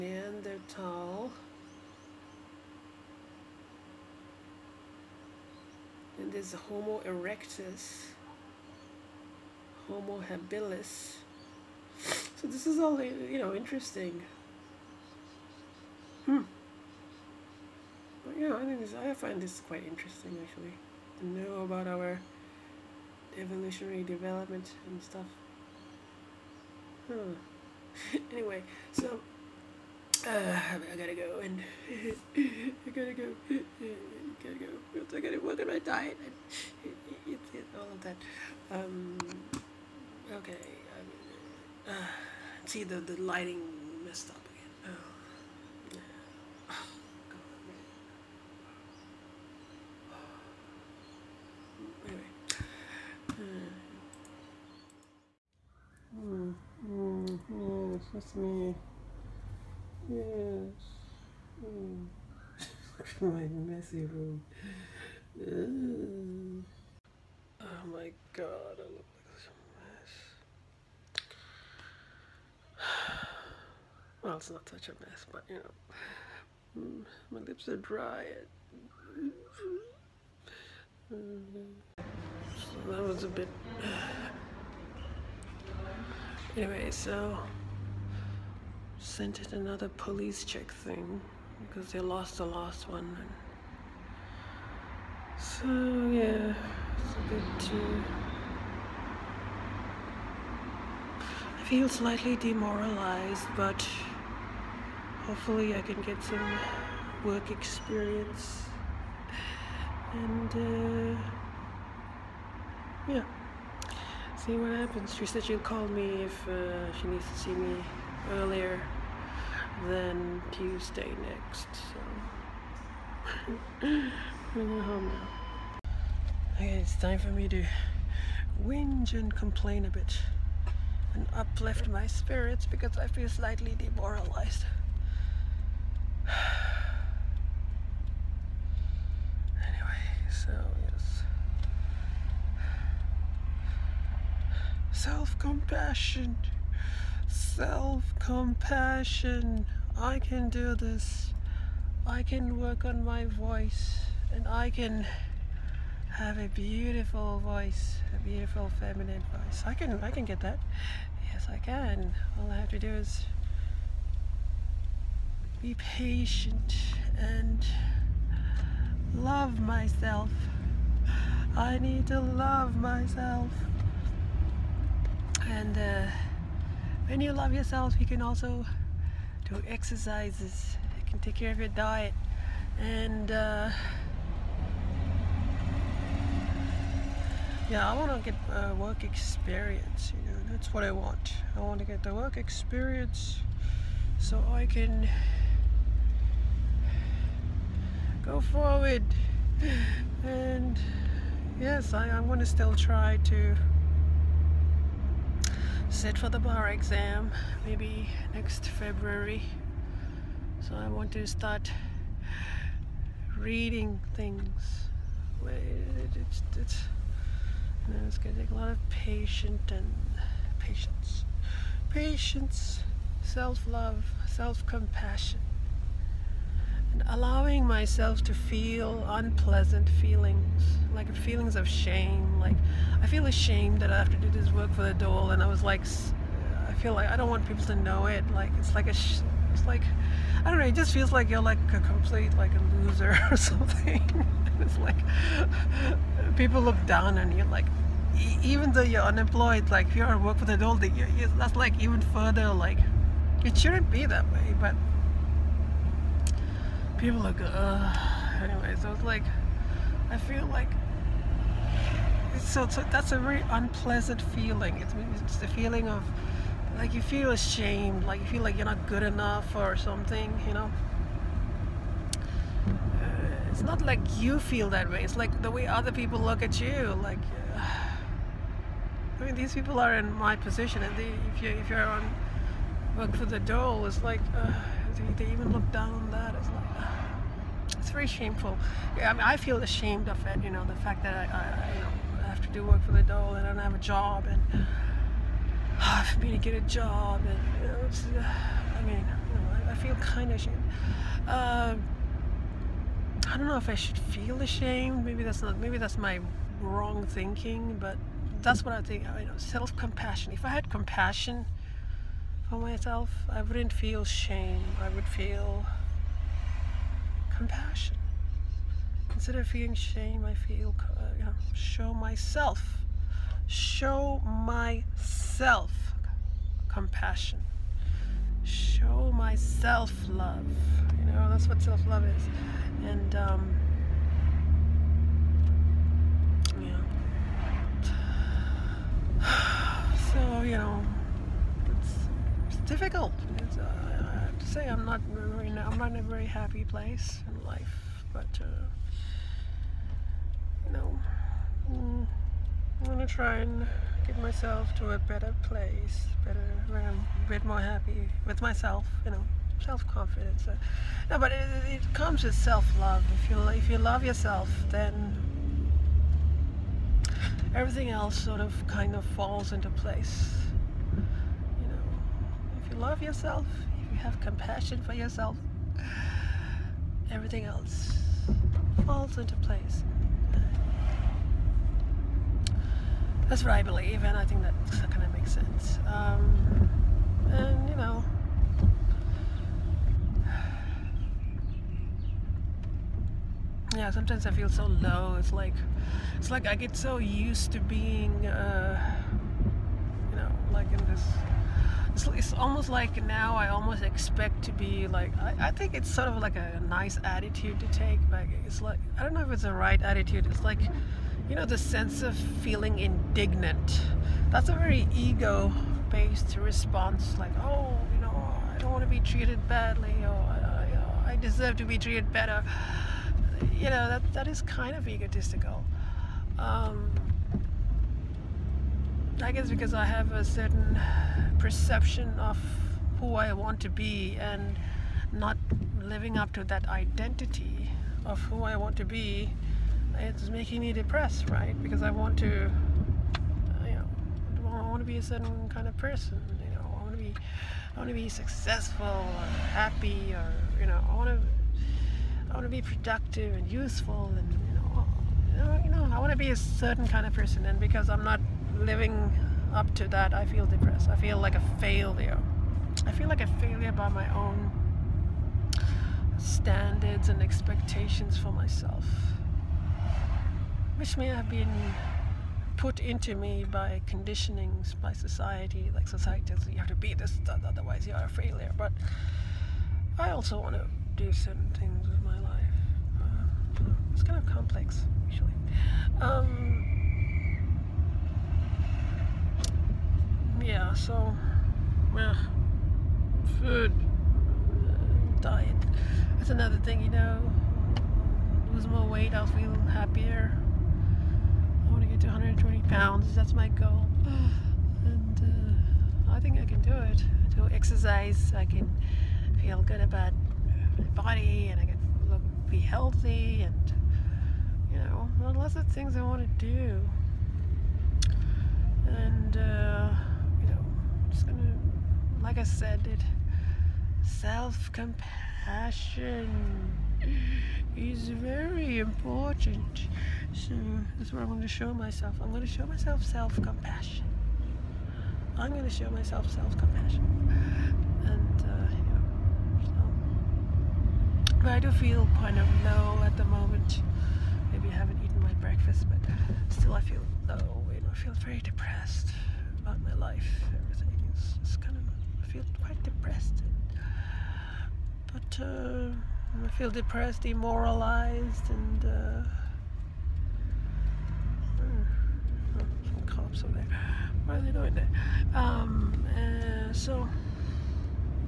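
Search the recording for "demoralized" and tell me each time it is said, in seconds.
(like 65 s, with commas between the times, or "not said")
102 s, 133 s, 557 s.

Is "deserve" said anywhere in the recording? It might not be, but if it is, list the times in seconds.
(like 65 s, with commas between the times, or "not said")
421 s.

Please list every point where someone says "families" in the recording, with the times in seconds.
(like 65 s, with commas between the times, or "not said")
not said.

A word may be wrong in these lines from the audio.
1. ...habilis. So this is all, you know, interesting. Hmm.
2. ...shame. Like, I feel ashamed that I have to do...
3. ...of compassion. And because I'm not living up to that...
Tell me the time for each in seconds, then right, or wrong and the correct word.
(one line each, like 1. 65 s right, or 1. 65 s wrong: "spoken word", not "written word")
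1. 10 s right
2. 231 s right
3. 457 s wrong: "person", not "compassion".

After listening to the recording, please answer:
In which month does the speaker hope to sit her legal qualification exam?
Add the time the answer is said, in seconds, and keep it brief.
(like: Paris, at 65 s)
February, at 208 s.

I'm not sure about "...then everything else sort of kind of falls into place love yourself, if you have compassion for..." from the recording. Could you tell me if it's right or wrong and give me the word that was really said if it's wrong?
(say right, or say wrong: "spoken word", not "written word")
right.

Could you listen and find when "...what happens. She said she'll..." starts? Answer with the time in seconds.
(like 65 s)
114 s.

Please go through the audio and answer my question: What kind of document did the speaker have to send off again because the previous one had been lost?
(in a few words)
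Police check.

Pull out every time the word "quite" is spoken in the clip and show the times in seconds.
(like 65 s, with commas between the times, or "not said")
19 s, 552 s.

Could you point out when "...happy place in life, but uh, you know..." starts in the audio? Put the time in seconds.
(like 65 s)
346 s.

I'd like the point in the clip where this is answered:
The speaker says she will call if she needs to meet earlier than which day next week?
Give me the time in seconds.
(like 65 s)
120 s.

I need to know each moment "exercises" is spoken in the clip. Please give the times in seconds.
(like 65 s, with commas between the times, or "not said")
179 s, 507 s.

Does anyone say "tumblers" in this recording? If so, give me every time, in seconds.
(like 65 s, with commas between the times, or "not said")
not said.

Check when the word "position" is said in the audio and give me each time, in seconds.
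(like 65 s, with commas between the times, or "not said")
280 s.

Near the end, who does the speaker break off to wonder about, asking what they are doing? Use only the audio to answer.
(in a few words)
Cops.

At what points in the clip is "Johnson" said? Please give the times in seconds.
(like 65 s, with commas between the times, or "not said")
not said.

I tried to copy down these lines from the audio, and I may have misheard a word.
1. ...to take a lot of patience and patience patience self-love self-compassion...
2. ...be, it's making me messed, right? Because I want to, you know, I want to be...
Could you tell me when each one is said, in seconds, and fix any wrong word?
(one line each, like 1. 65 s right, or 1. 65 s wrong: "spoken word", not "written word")
1. 218 s right
2. 438 s wrong: "depressed", not "messed".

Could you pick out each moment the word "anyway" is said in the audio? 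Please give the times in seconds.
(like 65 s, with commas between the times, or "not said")
28 s, 86 s, 139 s, 258 s.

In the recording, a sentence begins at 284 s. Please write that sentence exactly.
Uh, they, they even look down on that.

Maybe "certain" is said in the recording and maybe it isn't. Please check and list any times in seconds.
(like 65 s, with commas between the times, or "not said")
430 s, 445 s, 456 s, 481 s.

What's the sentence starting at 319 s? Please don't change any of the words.
Instead of feeling shame, I feel, uh, you know, show myself, show myself compassion, show myself love.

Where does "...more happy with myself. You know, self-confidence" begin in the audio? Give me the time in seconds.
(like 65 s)
357 s.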